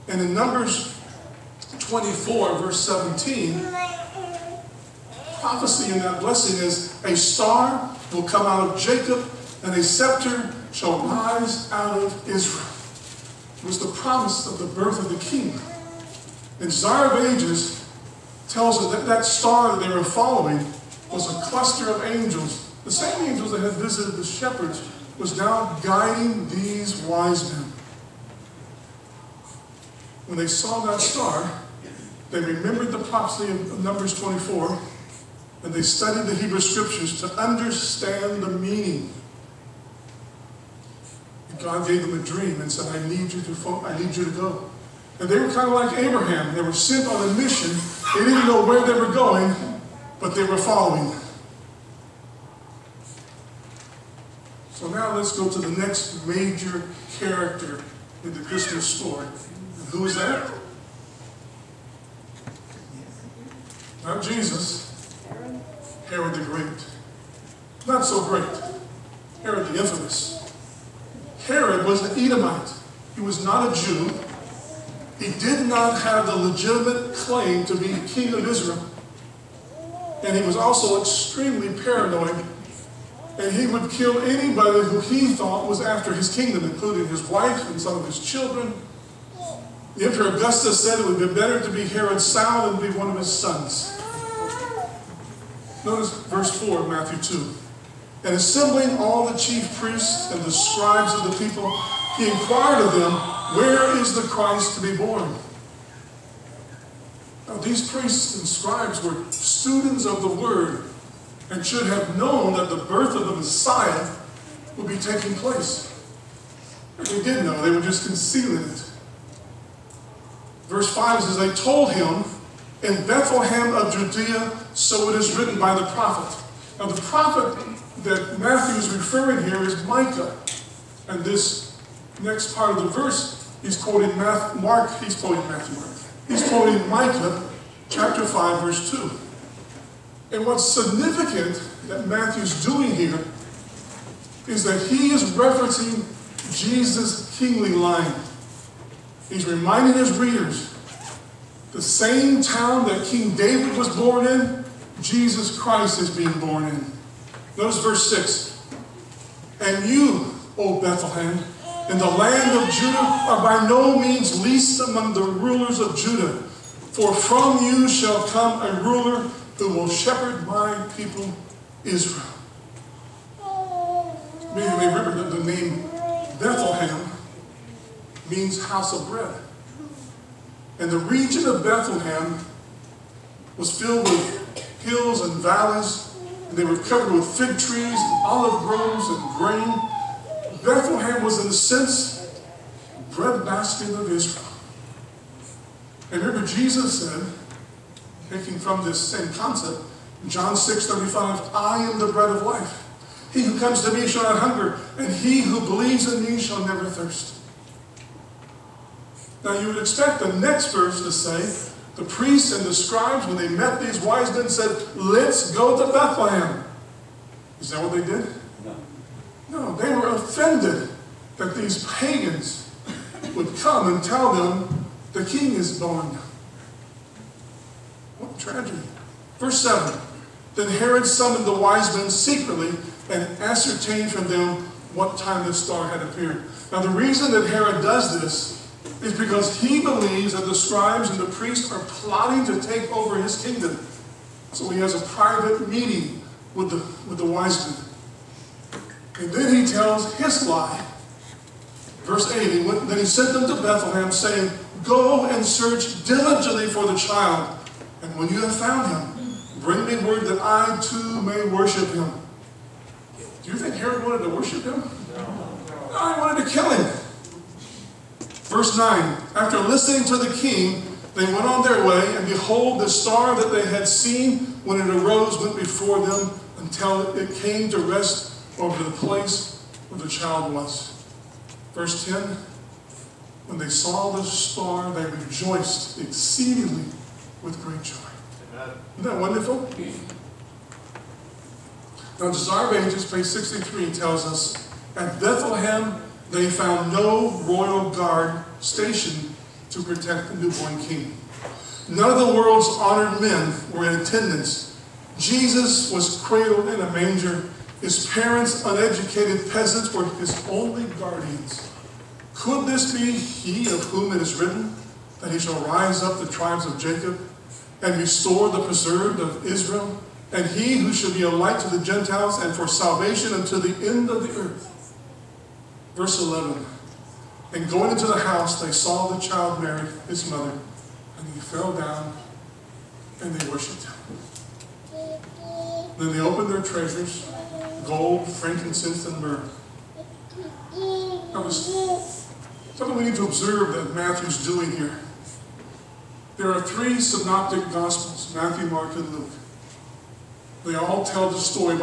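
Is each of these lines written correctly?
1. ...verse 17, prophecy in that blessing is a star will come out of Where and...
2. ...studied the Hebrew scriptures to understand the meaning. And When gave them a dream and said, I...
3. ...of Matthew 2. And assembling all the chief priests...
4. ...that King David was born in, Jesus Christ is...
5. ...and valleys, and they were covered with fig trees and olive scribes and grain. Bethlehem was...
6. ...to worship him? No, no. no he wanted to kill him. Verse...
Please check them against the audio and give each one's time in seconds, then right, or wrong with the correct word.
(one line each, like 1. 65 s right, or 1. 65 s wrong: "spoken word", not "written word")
1. 2 s wrong: "Jacob", not "Where"
2. 35 s wrong: "God", not "When"
3. 96 s right
4. 152 s right
5. 185 s wrong: "groves", not "scribes"
6. 264 s right.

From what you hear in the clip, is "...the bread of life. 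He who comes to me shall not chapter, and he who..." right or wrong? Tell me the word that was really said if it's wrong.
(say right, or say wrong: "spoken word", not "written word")
wrong: "hunger", not "chapter".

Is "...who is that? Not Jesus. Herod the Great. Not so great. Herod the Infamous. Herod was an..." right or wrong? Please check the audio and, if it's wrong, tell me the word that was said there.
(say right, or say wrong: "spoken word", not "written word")
right.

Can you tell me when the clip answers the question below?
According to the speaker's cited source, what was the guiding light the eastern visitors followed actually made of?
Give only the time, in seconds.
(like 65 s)
21 s.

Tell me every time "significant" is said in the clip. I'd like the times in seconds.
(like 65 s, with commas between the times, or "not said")
140 s.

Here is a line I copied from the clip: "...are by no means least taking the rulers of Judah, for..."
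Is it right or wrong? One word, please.
wrong.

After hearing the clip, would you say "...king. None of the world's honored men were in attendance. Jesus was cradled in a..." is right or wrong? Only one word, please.
right.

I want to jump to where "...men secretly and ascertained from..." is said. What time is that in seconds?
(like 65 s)
231 s.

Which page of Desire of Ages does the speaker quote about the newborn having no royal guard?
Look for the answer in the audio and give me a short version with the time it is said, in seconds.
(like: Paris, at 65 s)
63, at 293 s.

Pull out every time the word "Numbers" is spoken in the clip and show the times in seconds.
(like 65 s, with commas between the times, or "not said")
0 s, 33 s.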